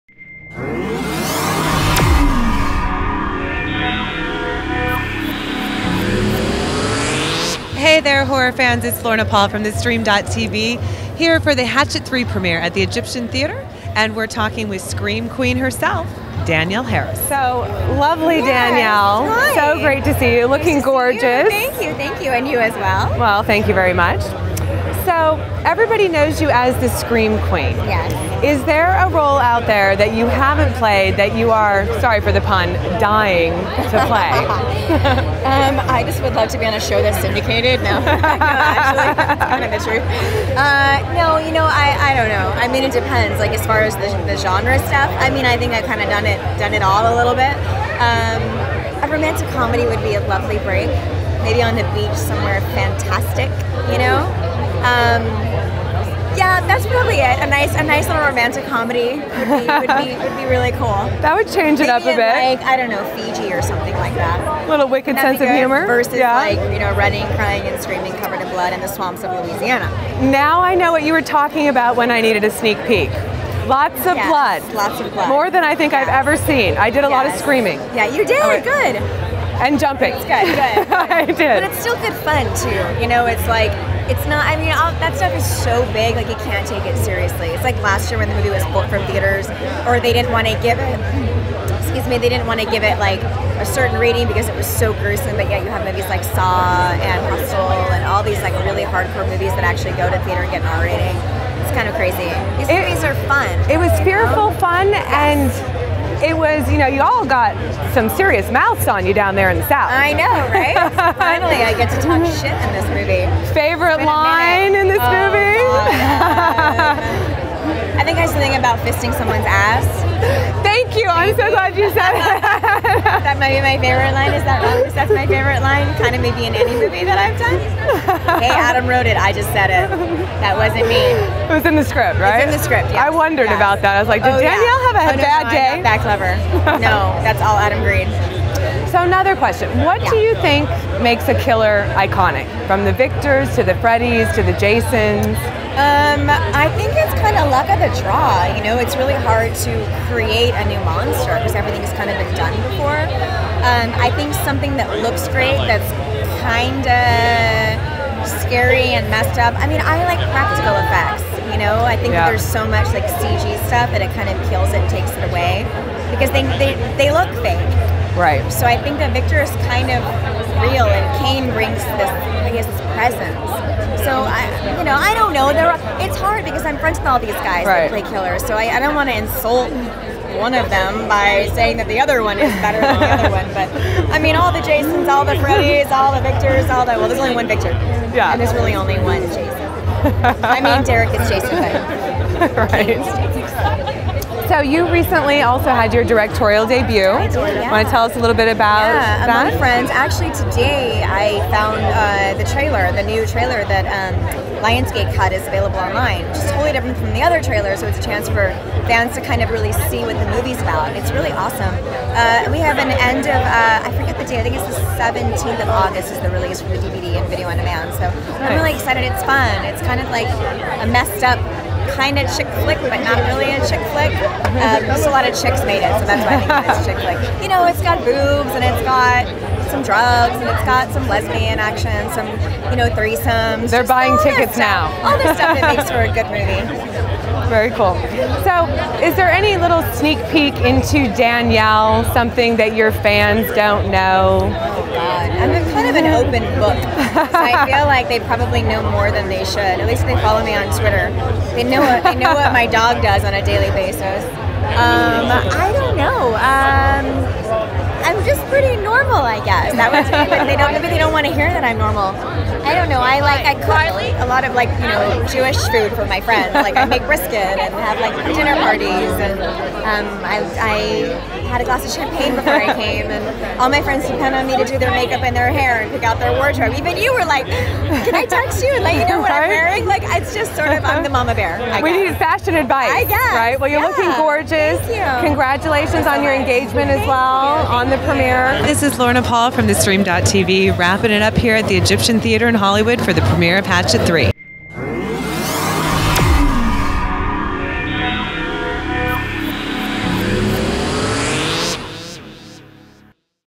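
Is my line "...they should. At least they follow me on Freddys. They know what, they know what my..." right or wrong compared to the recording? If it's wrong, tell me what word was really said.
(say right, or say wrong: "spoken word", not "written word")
wrong: "Twitter", not "Freddys".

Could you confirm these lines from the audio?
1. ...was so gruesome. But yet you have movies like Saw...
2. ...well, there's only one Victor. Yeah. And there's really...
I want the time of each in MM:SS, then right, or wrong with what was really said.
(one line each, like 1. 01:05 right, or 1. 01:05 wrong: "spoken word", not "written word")
1. 01:34 right
2. 03:06 right.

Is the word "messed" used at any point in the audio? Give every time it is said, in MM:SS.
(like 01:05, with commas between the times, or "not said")
02:39, 03:40.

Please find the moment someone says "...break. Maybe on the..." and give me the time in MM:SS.
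00:50.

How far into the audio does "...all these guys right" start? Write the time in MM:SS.
02:57.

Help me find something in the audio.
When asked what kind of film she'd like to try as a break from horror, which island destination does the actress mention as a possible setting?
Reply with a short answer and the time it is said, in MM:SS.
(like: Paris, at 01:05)
Fiji, at 01:03.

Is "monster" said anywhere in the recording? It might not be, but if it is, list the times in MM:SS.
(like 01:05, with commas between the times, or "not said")
02:30.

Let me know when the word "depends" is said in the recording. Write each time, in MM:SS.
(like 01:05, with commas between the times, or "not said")
00:42, 04:34.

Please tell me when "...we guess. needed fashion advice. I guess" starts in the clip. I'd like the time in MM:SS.
04:41.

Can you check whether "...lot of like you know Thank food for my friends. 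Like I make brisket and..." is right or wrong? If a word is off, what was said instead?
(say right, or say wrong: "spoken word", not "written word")
wrong: "Jewish", not "Thank".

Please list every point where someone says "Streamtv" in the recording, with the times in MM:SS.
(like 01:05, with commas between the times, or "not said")
00:09, 04:49.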